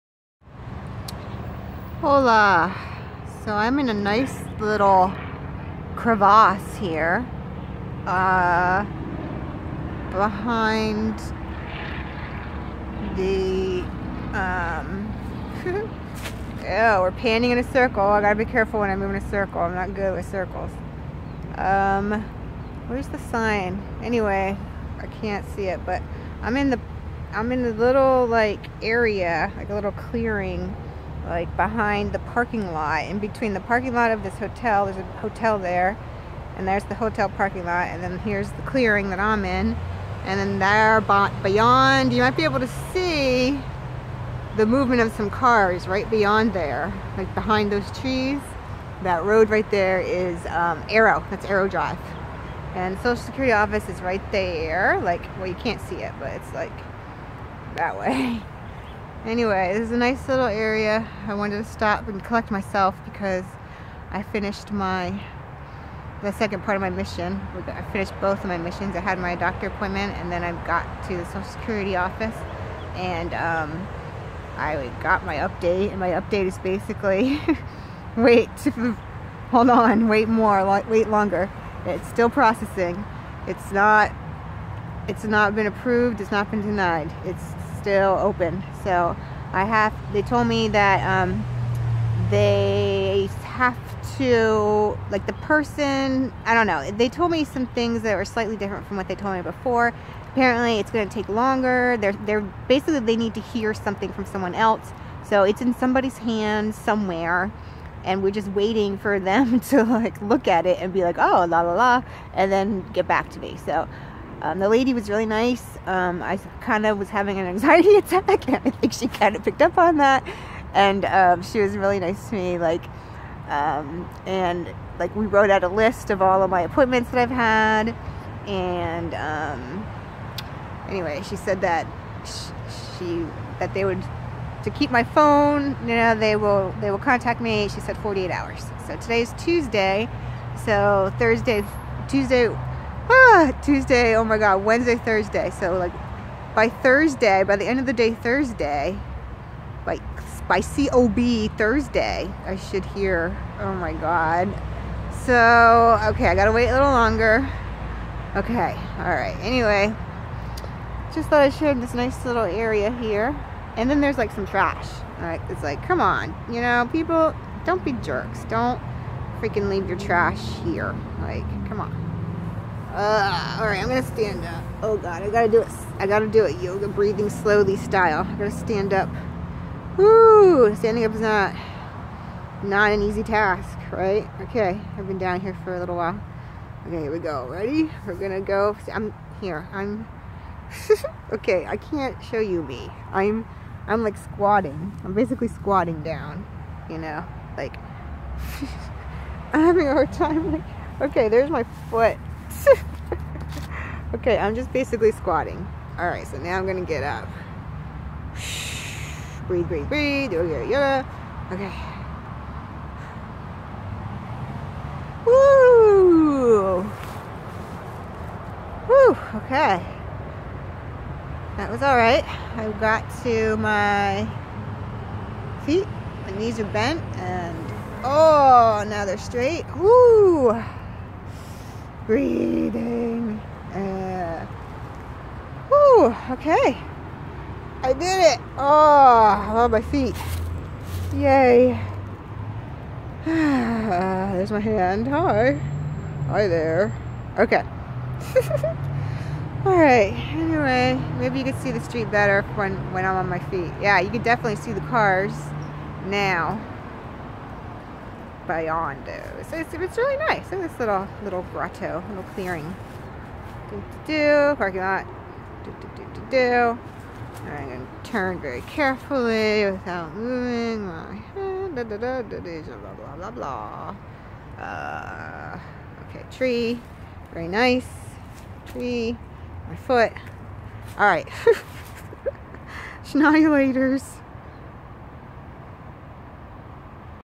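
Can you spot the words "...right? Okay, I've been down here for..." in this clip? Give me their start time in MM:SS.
03:03.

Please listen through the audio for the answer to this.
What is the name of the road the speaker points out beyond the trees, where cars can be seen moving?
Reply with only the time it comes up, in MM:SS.
00:51.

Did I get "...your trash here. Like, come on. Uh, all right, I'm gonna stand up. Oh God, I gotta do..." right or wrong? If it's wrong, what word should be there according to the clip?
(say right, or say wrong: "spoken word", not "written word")
right.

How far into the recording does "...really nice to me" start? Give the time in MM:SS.
02:01.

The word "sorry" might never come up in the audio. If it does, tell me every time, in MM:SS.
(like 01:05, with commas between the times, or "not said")
not said.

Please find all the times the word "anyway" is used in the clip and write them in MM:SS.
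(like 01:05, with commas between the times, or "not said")
00:24, 00:59, 02:10, 02:39, 04:10.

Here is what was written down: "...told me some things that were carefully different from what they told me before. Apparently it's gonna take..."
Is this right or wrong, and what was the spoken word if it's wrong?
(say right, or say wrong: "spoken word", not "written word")
wrong: "slightly", not "carefully".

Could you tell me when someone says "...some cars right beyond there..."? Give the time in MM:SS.
00:45.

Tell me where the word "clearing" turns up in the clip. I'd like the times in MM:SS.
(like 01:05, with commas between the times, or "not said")
00:29, 00:38, 04:22.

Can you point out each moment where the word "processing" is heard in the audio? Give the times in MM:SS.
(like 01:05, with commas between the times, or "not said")
01:22.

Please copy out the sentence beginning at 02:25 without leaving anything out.
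So like by Thursday, by the end of the day Thursday, by, by COB Thursday, I should hear, oh my God.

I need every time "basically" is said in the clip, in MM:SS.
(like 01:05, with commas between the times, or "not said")
01:16, 01:42, 03:15, 03:24.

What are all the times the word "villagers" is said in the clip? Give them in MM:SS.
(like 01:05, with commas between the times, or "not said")
not said.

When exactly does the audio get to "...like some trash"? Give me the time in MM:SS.
02:44.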